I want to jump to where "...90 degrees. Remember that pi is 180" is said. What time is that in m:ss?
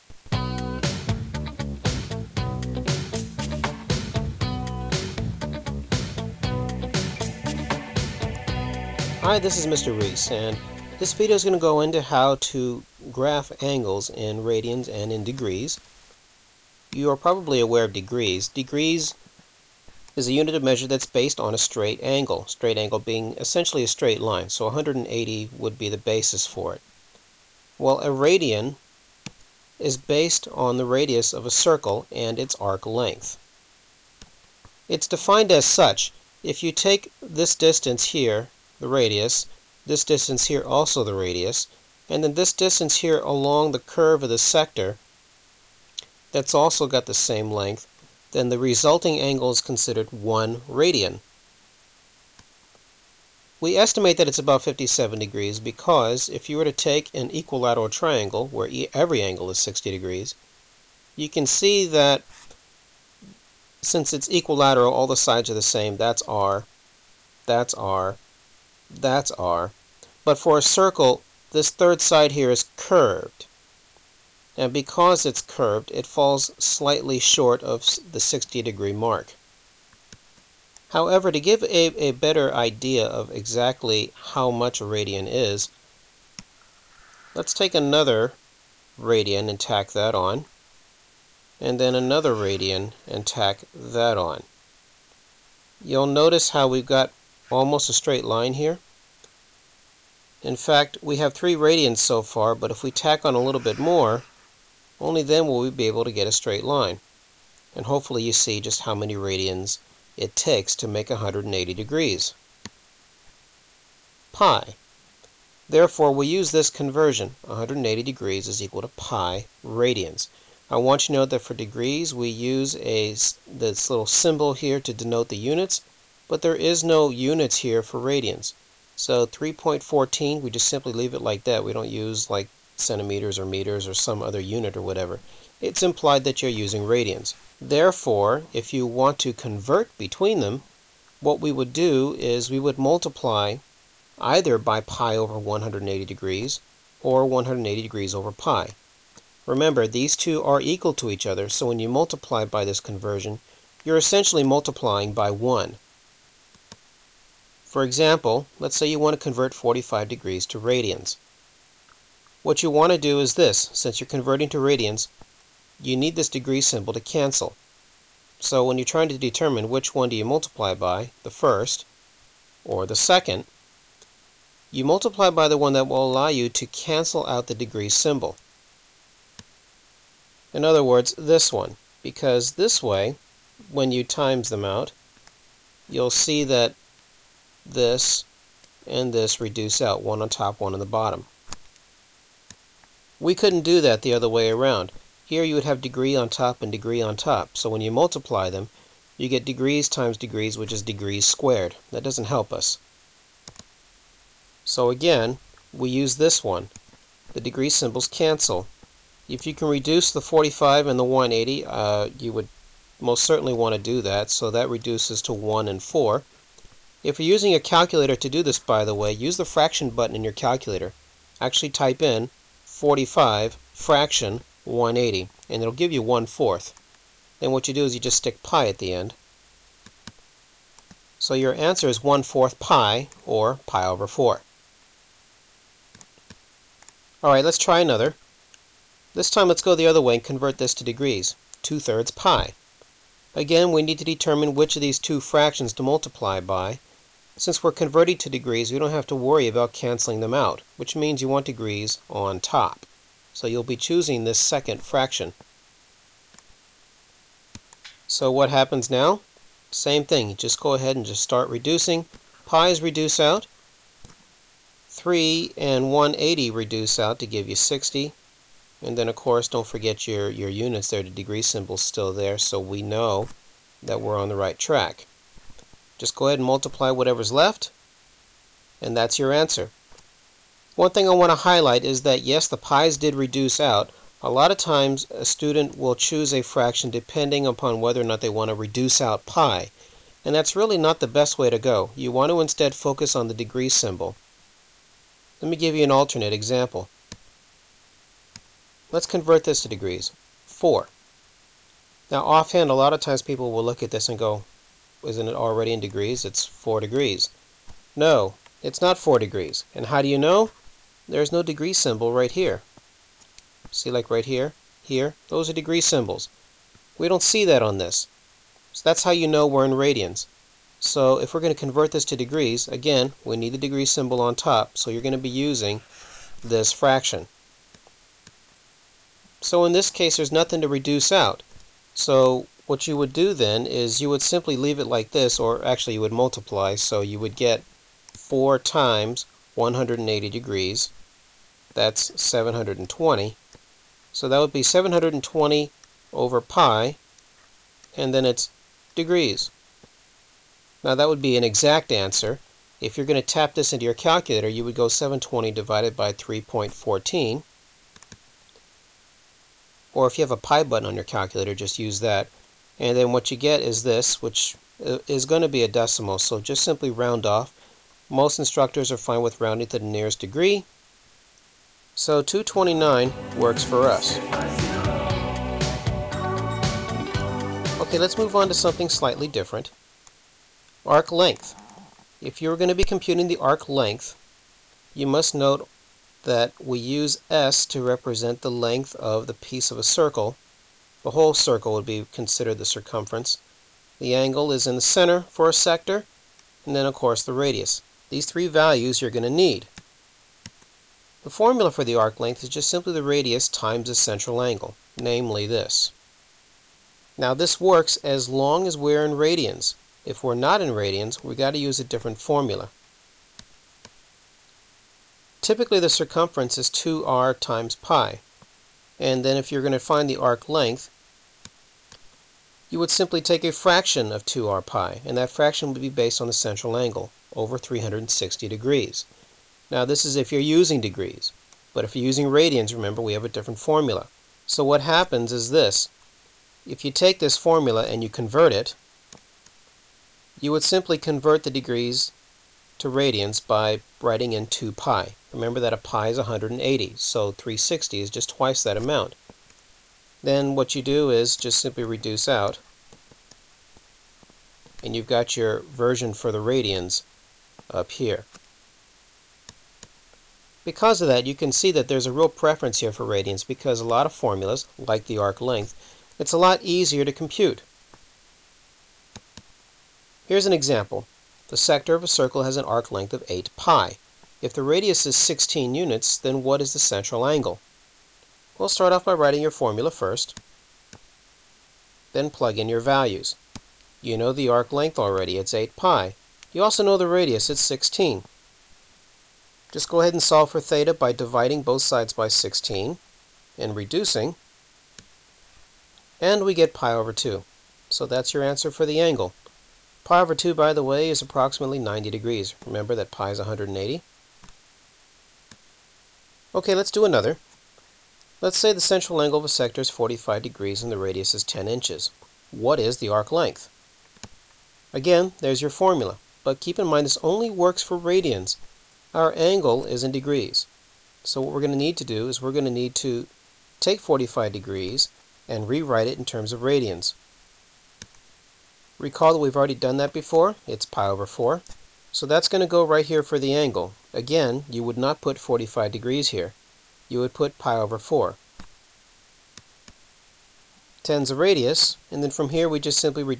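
8:21.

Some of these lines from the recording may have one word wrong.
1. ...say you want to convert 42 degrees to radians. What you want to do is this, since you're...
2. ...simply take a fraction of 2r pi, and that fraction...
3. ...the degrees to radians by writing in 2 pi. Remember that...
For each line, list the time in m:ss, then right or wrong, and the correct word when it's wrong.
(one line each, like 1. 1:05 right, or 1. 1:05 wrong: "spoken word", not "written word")
1. 2:38 wrong: "45", not "42"
2. 7:02 right
3. 7:21 right.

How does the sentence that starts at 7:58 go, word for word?
We'll start off by writing your formula first, then plug in your values.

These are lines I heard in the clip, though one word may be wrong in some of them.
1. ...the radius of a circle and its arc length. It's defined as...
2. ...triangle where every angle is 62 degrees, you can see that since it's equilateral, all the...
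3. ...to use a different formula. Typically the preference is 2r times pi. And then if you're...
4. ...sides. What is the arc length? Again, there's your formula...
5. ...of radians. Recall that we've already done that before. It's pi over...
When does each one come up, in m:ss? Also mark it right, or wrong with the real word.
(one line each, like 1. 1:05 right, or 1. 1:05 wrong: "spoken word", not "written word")
1. 0:30 right
2. 0:57 wrong: "60", not "62"
3. 6:51 wrong: "circumference", not "preference"
4. 8:31 wrong: "inches", not "sides"
5. 8:46 right.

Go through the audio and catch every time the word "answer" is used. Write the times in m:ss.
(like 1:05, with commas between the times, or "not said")
3:51, 4:39, 5:51, 8:18.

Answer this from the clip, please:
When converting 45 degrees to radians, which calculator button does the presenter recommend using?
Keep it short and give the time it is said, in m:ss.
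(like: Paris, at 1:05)
fraction button, at 3:39.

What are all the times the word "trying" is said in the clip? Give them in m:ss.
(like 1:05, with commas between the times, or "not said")
2:48.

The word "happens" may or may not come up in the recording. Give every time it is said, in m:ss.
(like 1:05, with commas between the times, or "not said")
4:18, 7:14.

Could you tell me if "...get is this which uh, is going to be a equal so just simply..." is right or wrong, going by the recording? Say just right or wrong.
wrong.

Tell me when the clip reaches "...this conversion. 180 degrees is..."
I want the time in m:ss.
1:56.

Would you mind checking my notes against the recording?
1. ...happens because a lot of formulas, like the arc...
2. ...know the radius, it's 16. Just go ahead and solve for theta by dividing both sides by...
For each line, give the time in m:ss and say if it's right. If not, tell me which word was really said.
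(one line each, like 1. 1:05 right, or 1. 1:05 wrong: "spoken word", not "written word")
1. 7:43 wrong: "radians", not "happens"
2. 8:06 right.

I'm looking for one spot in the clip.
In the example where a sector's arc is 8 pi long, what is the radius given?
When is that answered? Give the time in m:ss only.
7:55.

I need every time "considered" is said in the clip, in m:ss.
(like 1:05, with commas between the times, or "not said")
0:49, 6:32.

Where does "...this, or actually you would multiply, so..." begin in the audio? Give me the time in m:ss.
5:35.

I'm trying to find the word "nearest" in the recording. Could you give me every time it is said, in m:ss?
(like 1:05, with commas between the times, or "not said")
6:09.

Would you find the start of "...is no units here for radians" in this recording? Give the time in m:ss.
2:06.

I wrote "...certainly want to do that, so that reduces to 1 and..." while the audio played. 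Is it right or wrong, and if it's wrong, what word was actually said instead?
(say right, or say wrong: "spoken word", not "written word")
right.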